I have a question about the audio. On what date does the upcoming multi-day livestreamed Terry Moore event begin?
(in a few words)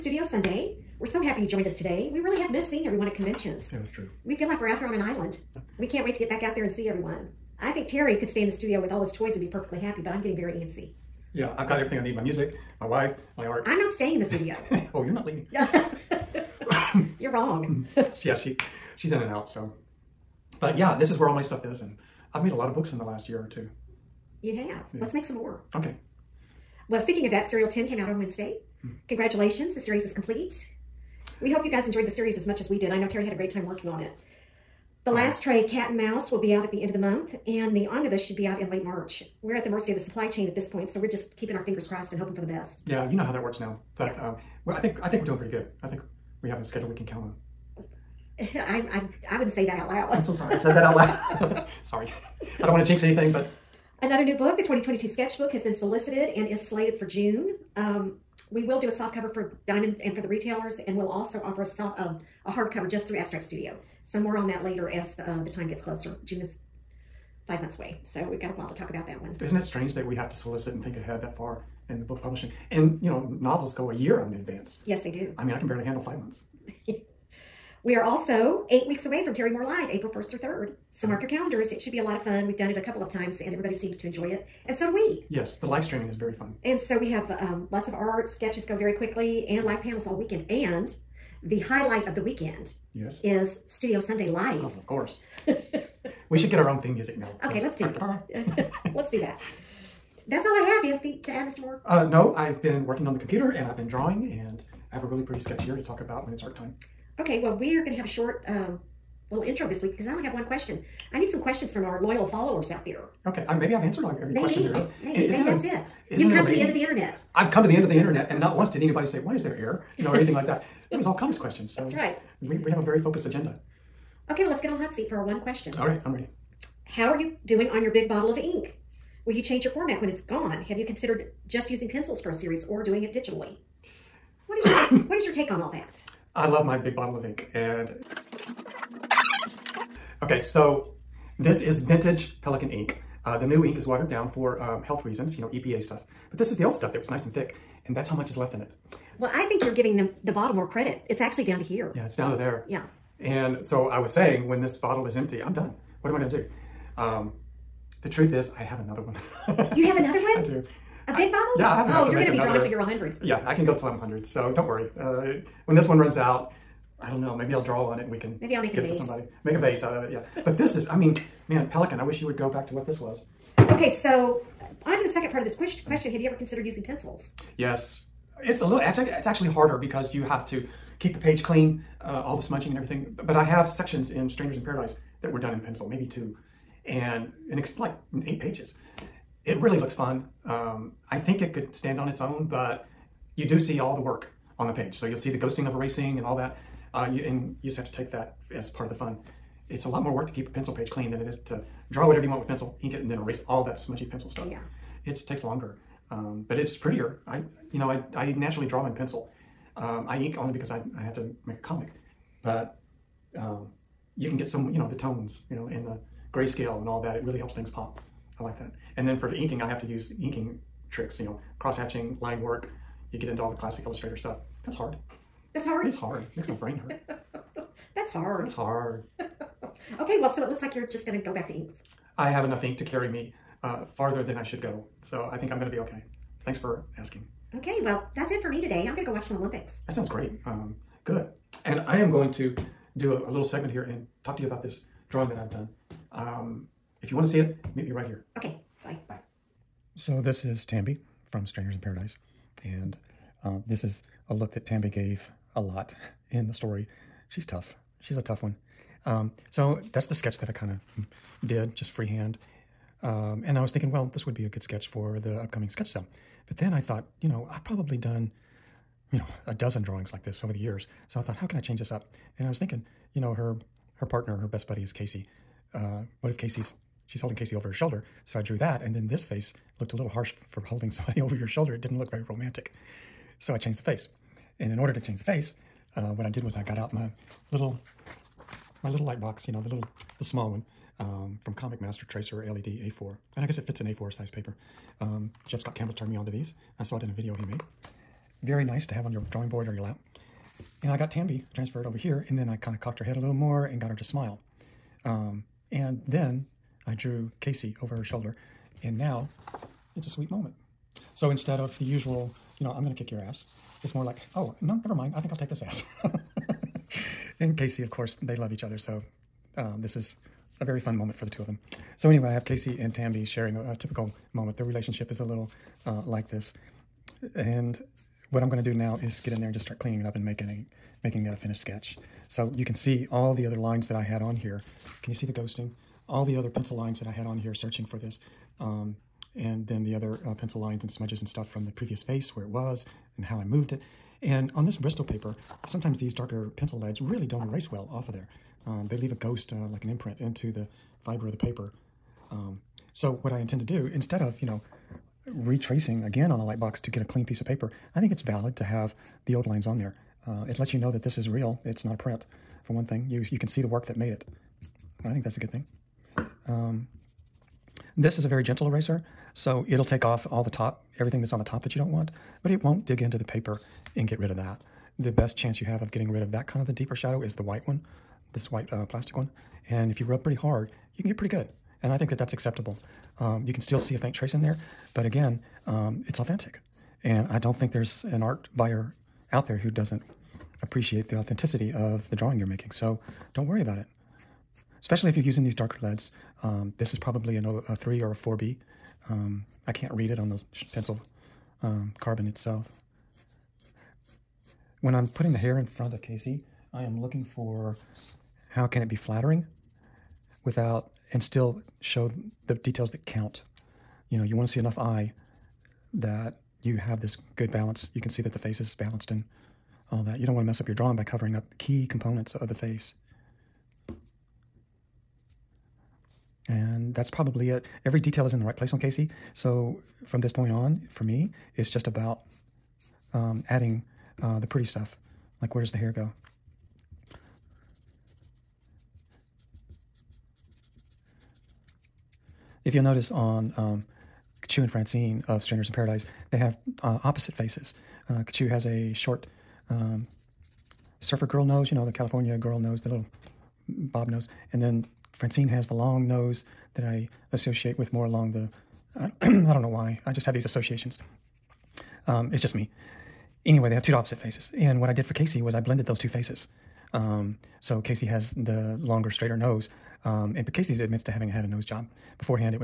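April 1st.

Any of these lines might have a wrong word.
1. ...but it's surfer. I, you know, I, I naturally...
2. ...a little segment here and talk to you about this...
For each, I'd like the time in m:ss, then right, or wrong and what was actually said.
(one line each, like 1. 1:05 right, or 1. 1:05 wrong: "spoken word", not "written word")
1. 3:26 wrong: "prettier", not "surfer"
2. 4:03 right.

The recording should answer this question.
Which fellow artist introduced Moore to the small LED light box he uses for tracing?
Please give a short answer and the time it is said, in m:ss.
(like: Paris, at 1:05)
J. Scott Campbell, at 4:55.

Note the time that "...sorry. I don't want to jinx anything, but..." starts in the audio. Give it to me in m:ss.
0:51.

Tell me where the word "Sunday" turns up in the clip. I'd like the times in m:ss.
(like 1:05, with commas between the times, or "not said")
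0:00, 1:33.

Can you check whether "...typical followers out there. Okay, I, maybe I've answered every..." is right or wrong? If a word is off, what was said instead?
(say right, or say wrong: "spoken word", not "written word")
wrong: "loyal", not "typical".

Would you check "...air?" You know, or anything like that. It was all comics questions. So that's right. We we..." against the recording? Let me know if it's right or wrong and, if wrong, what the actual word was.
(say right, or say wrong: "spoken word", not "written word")
right.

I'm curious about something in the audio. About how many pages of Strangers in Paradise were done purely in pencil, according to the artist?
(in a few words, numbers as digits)
8.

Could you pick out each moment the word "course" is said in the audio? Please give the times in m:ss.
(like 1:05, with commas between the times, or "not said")
1:34, 5:17.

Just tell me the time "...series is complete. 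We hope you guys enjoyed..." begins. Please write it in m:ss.
0:29.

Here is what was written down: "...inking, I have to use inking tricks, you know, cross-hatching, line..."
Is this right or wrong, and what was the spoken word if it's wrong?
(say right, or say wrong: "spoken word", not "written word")
right.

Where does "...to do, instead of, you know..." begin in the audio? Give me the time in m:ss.
5:53.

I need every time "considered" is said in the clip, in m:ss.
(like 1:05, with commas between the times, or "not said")
2:10, 2:56.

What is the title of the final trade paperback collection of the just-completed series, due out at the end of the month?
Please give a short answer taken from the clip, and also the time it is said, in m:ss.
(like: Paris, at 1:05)
Cat and Mouse, at 0:35.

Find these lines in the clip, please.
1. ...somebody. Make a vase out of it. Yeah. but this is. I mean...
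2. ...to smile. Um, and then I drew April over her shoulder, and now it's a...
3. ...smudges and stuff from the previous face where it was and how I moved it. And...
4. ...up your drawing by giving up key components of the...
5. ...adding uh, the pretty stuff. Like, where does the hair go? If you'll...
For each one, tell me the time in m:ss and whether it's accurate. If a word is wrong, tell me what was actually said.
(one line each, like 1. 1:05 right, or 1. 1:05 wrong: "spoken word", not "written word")
1. 2:49 right
2. 5:03 wrong: "Casey", not "April"
3. 5:40 right
4. 7:00 wrong: "covering", not "giving"
5. 7:13 right.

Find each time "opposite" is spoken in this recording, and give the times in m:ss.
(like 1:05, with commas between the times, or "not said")
7:27, 7:43.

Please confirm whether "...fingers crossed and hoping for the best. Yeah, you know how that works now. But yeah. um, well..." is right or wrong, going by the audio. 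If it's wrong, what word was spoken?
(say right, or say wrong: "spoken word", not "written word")
right.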